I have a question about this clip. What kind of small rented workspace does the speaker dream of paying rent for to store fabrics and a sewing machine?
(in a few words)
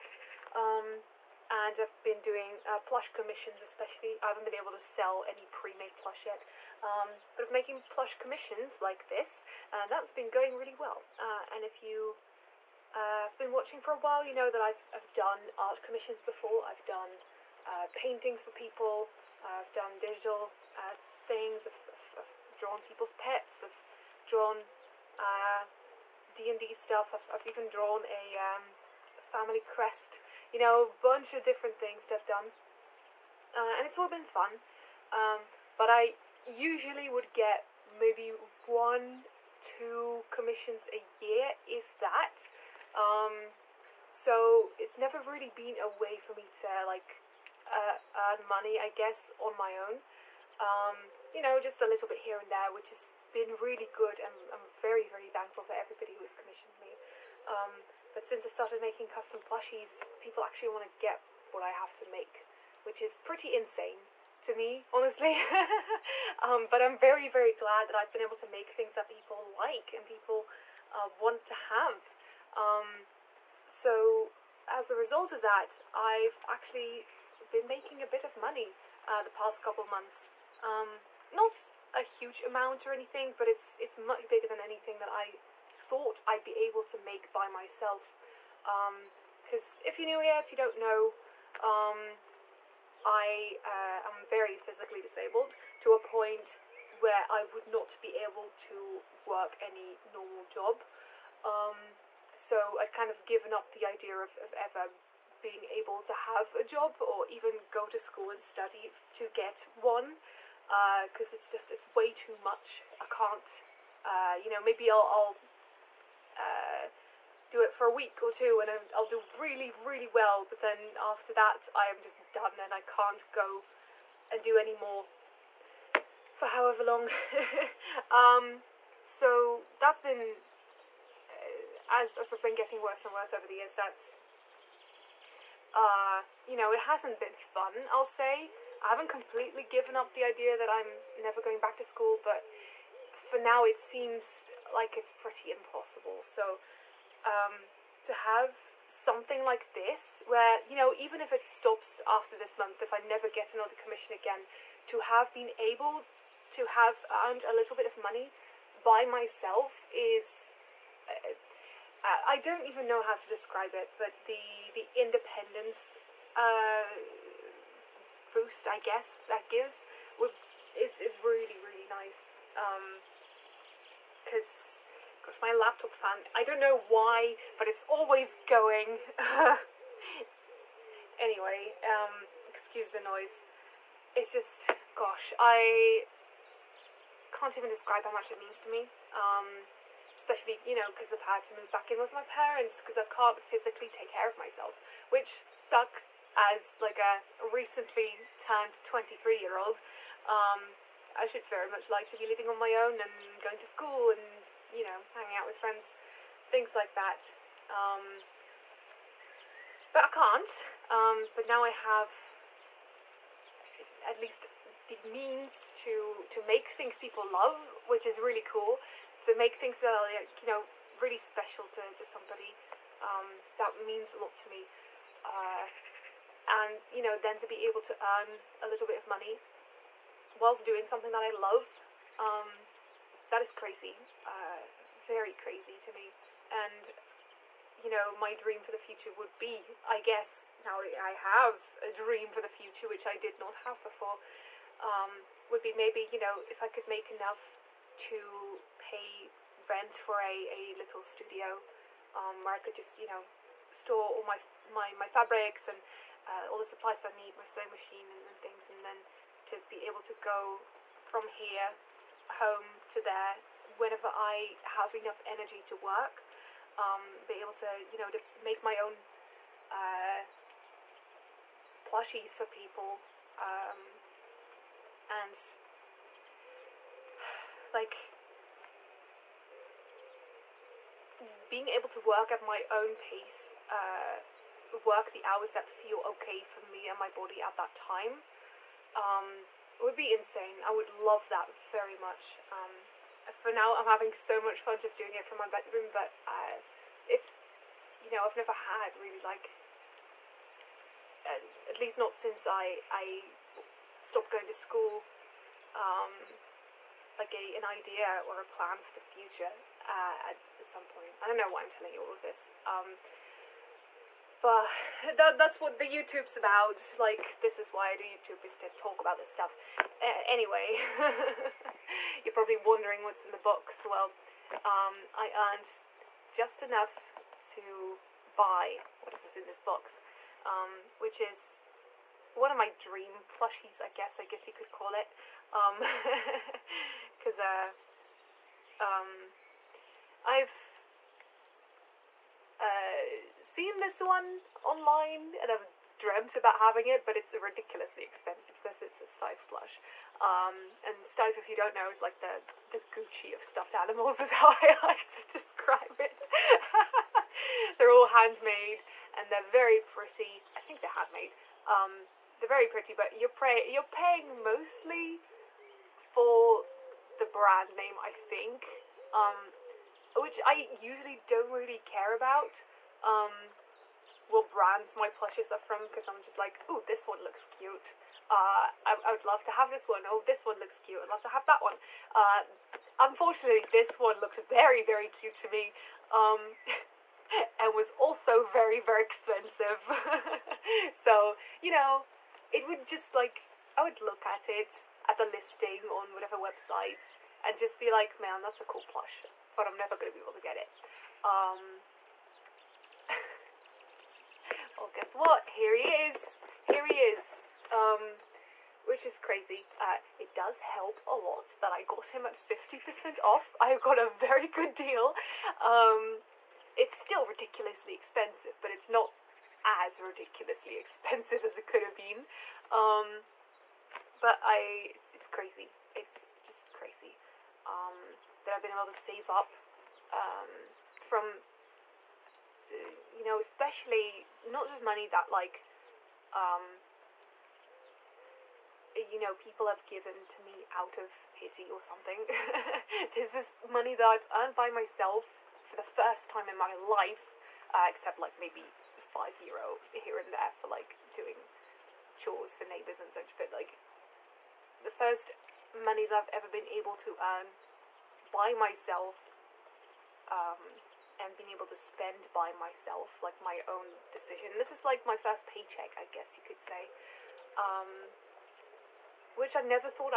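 a little studio.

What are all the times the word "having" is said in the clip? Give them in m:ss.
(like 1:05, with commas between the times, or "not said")
4:53, 5:46.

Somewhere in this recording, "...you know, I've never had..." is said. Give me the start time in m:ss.
4:58.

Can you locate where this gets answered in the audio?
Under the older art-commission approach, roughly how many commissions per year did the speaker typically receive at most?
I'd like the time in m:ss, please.
0:38.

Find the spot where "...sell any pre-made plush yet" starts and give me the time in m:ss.
0:04.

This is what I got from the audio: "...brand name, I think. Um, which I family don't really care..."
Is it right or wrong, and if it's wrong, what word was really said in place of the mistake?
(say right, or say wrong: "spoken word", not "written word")
wrong: "usually", not "family".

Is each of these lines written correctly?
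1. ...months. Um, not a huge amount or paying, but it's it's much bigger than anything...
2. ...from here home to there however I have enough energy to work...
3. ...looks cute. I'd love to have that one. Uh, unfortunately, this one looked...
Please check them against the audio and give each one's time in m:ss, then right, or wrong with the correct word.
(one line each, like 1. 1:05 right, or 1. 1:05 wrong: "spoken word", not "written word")
1. 1:19 wrong: "anything", not "paying"
2. 4:21 wrong: "whenever", not "however"
3. 6:20 right.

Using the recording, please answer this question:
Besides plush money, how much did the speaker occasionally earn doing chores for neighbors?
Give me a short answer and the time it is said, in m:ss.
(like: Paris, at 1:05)
5 euro, at 7:28.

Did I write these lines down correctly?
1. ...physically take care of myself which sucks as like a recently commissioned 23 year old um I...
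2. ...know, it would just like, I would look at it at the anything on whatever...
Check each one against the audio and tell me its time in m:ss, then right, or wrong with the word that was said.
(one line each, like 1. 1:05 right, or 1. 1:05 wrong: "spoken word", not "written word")
1. 3:13 wrong: "turned", not "commissioned"
2. 6:31 wrong: "listing", not "anything".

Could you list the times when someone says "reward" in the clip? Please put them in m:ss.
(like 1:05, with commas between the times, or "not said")
not said.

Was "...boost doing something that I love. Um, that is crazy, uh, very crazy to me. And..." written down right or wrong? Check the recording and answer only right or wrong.
wrong.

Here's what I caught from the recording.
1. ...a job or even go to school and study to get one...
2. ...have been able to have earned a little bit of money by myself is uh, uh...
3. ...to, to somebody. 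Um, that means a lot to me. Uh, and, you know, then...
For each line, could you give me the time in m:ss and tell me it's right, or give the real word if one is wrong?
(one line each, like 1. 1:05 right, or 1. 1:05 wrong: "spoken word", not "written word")
1. 1:46 right
2. 2:34 right
3. 3:41 right.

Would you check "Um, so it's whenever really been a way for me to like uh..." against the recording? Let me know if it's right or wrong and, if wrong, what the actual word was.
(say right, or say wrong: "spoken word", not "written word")
wrong: "never", not "whenever".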